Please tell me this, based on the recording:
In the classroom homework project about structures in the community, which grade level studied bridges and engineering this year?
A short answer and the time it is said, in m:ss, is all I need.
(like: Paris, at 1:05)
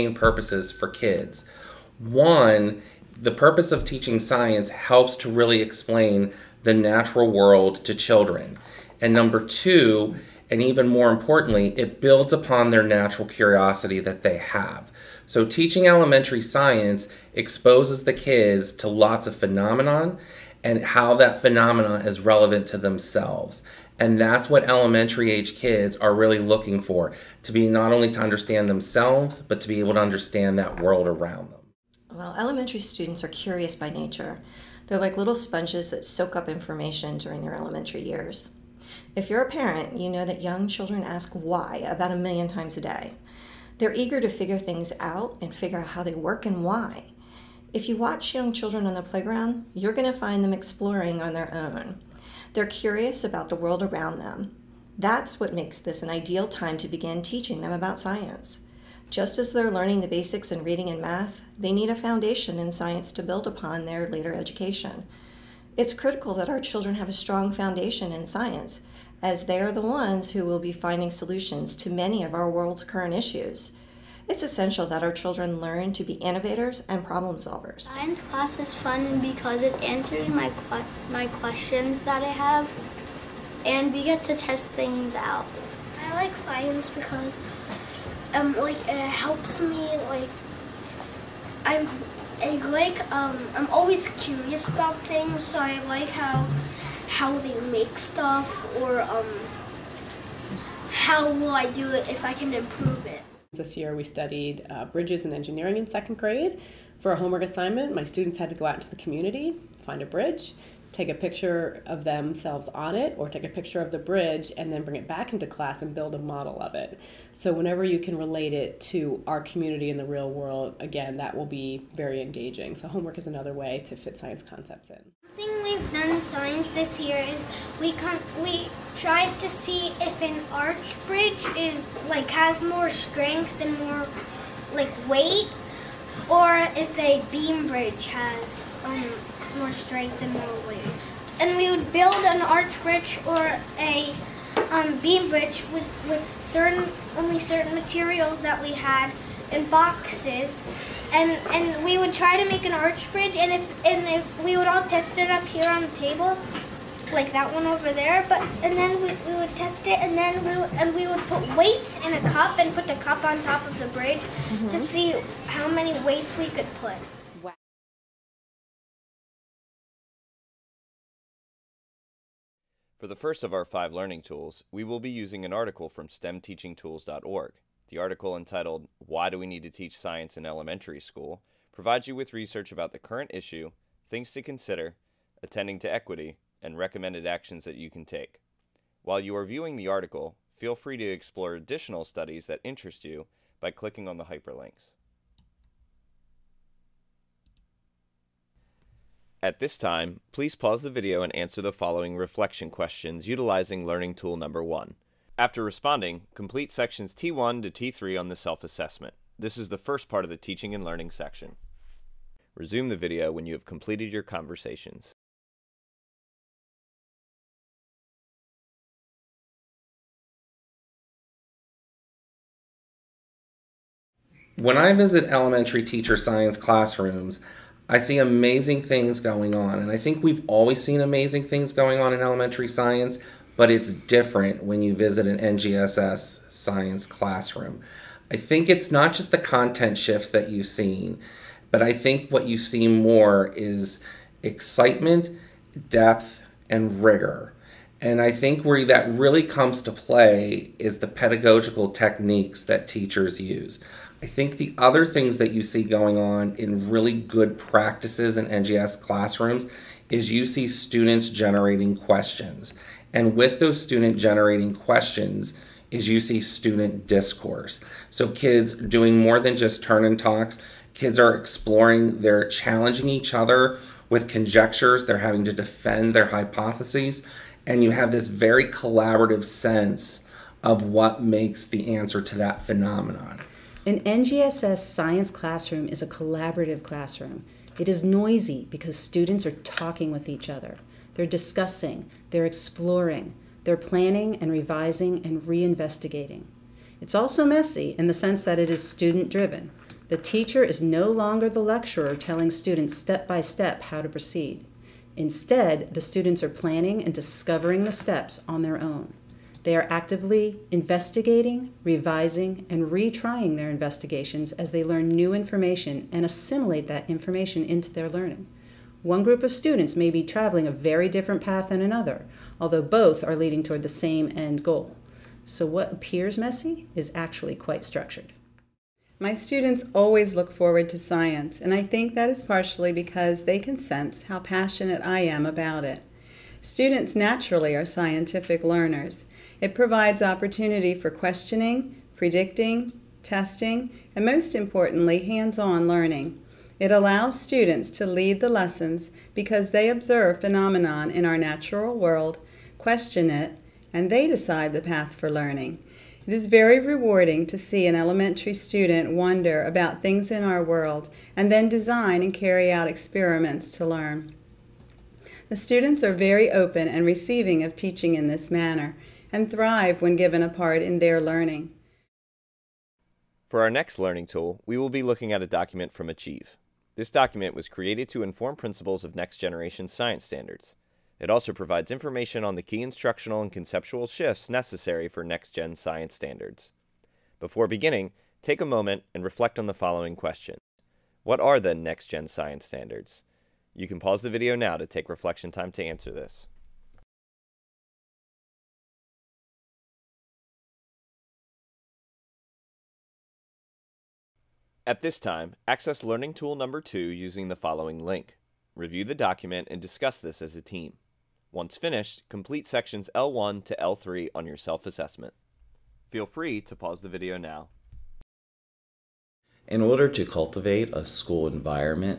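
second grade, at 1:45.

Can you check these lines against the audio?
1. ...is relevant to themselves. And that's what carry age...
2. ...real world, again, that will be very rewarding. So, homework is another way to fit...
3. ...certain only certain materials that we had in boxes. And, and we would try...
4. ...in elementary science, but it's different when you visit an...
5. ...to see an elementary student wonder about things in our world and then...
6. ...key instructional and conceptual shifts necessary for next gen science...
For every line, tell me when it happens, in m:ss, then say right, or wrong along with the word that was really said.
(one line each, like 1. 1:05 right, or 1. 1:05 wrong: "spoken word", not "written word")
1. 0:22 wrong: "elementary", not "carry"
2. 2:00 wrong: "engaging", not "rewarding"
3. 2:26 right
4. 3:52 right
5. 5:57 right
6. 6:22 right.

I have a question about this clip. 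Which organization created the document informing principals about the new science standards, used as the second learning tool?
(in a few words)
Achieve.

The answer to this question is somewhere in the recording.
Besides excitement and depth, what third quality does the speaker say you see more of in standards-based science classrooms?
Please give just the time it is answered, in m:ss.
4:07.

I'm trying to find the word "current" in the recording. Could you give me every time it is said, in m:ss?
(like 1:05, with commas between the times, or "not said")
1:12, 3:02.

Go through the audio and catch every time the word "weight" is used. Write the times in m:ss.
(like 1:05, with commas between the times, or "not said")
2:15, 2:20, 2:41, 2:46.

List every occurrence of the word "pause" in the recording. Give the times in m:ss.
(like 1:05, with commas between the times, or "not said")
3:20, 6:33, 6:56.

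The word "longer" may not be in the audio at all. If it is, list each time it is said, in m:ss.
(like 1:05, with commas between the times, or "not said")
5:01.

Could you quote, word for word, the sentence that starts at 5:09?
They are actively investigating, revising, and retrying their investigations as they learn new information and assimilate that information into their learning.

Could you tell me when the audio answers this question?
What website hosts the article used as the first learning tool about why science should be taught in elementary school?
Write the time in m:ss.
2:56.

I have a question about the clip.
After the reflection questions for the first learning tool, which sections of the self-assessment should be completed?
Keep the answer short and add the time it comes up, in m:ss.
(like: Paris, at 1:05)
T1 to T3, at 3:27.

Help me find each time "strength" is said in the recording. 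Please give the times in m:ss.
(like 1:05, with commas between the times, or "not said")
2:12, 2:19.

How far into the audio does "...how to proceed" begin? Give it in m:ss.
5:03.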